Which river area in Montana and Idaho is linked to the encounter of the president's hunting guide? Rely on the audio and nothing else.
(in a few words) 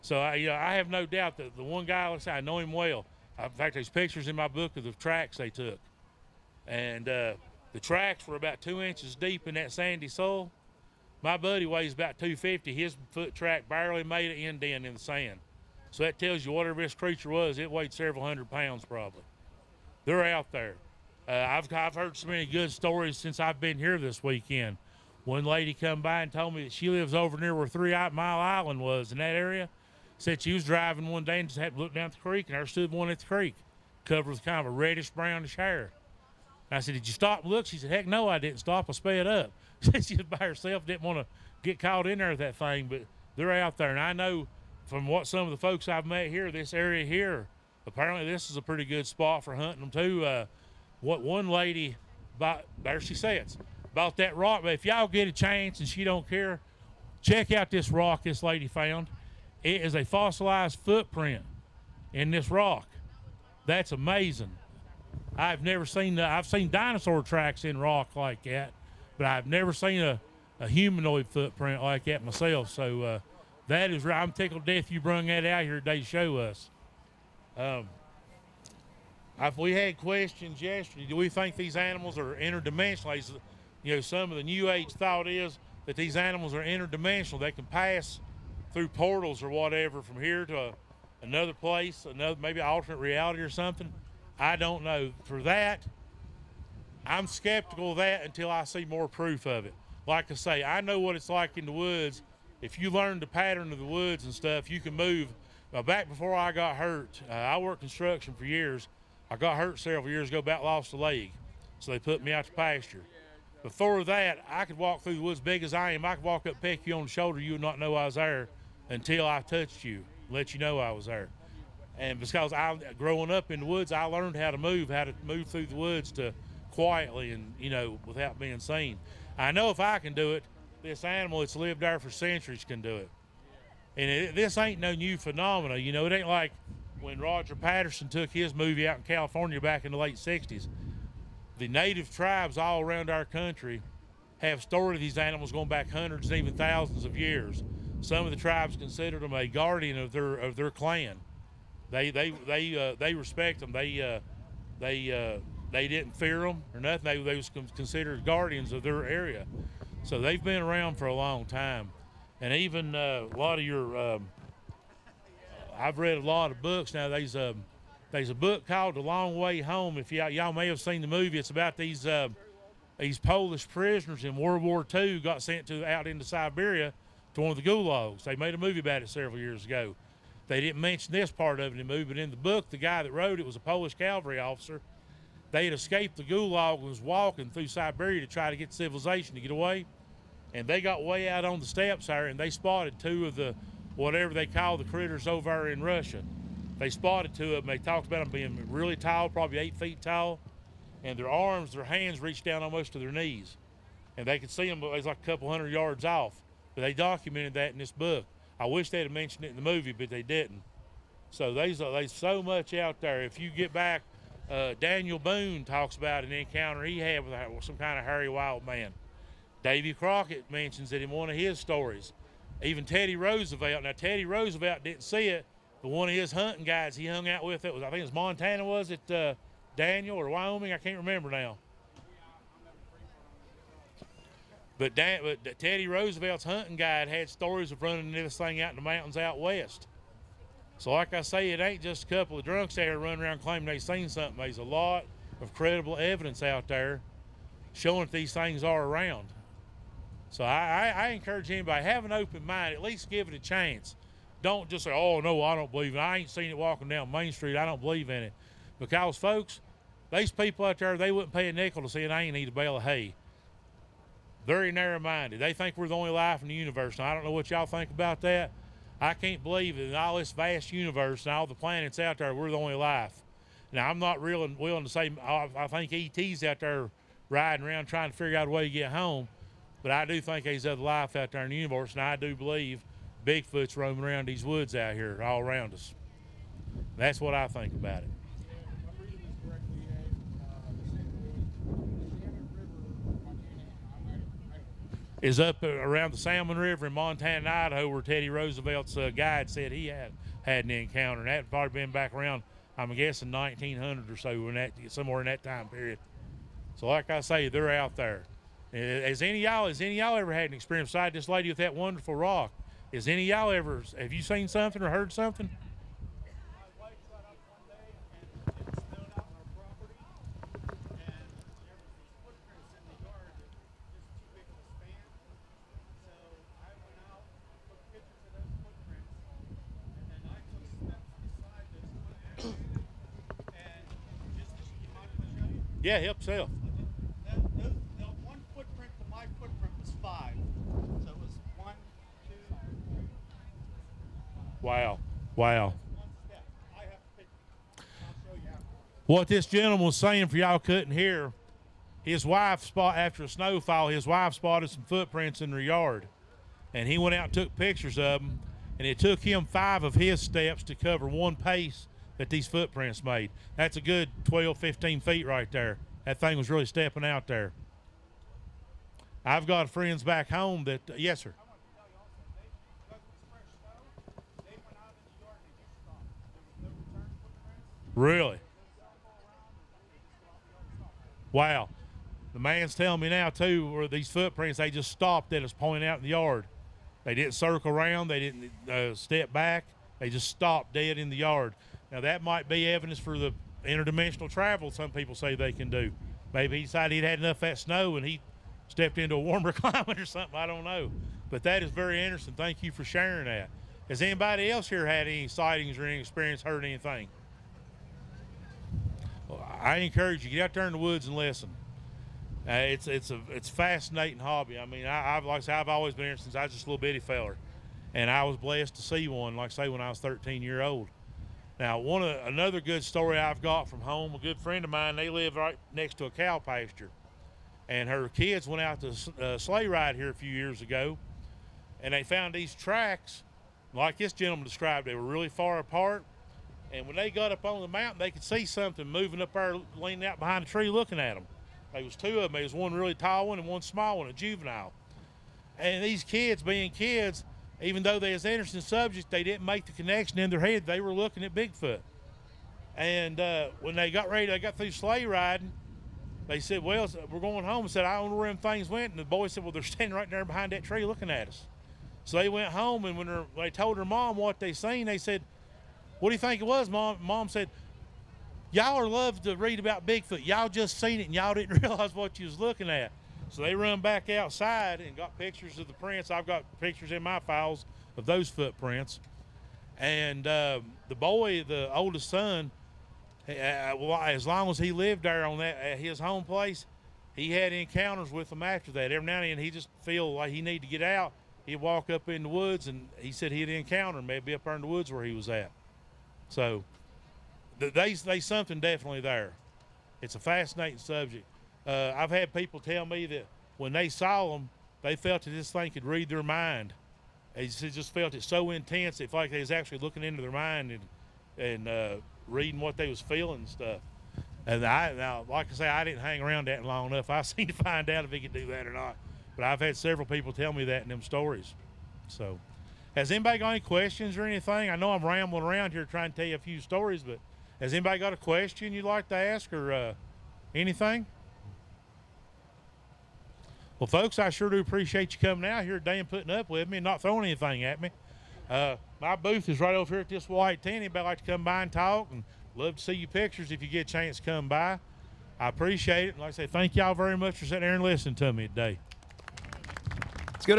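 Salmon River.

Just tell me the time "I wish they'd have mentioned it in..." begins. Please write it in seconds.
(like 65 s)
208 s.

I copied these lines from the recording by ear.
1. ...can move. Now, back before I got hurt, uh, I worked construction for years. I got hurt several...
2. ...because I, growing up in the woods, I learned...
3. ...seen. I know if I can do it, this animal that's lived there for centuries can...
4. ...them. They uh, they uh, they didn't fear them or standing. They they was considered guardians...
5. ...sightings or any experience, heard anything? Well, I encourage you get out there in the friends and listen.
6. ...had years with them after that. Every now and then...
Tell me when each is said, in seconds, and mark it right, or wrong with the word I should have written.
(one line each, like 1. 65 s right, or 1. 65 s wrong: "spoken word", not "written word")
1. 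104 s right
2. 122 s right
3. 128 s right
4. 153 s wrong: "nothing", not "standing"
5. 405 s wrong: "woods", not "friends"
6. 487 s wrong: "encounters", not "years".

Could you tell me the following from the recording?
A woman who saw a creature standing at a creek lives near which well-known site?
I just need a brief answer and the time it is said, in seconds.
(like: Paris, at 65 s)
Three Mile Island, at 27 s.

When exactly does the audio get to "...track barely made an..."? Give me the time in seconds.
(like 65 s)
13 s.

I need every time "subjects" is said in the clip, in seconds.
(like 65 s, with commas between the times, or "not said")
448 s, 500 s.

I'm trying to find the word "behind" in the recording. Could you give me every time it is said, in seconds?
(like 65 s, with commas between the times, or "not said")
440 s, 460 s.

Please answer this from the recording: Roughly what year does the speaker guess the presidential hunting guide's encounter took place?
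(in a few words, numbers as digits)
1900.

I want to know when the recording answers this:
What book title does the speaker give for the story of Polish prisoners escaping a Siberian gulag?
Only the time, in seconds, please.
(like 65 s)
168 s.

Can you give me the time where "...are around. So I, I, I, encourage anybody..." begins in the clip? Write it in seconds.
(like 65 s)
248 s.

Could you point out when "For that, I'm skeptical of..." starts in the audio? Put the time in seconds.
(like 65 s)
95 s.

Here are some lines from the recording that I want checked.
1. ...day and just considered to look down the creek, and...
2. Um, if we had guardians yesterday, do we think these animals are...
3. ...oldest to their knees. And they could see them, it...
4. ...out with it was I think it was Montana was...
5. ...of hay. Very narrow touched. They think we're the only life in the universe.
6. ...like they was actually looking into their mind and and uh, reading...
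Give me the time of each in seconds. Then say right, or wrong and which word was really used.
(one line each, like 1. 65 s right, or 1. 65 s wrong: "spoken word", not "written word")
1. 31 s wrong: "happened", not "considered"
2. 77 s wrong: "questions", not "guardians"
3. 202 s wrong: "almost", not "oldest"
4. 227 s right
5. 262 s wrong: "minded", not "touched"
6. 509 s right.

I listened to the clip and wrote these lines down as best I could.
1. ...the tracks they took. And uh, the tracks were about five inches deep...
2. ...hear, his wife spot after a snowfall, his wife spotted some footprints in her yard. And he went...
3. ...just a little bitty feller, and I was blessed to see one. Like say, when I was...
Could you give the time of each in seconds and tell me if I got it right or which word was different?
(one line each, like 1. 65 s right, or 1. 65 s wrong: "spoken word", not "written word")
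1. 4 s wrong: "two", not "five"
2. 350 s right
3. 416 s right.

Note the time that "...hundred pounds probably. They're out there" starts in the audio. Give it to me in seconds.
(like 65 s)
18 s.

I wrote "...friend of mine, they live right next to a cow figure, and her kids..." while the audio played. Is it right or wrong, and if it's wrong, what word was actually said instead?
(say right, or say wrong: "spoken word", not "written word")
wrong: "pasture", not "figure".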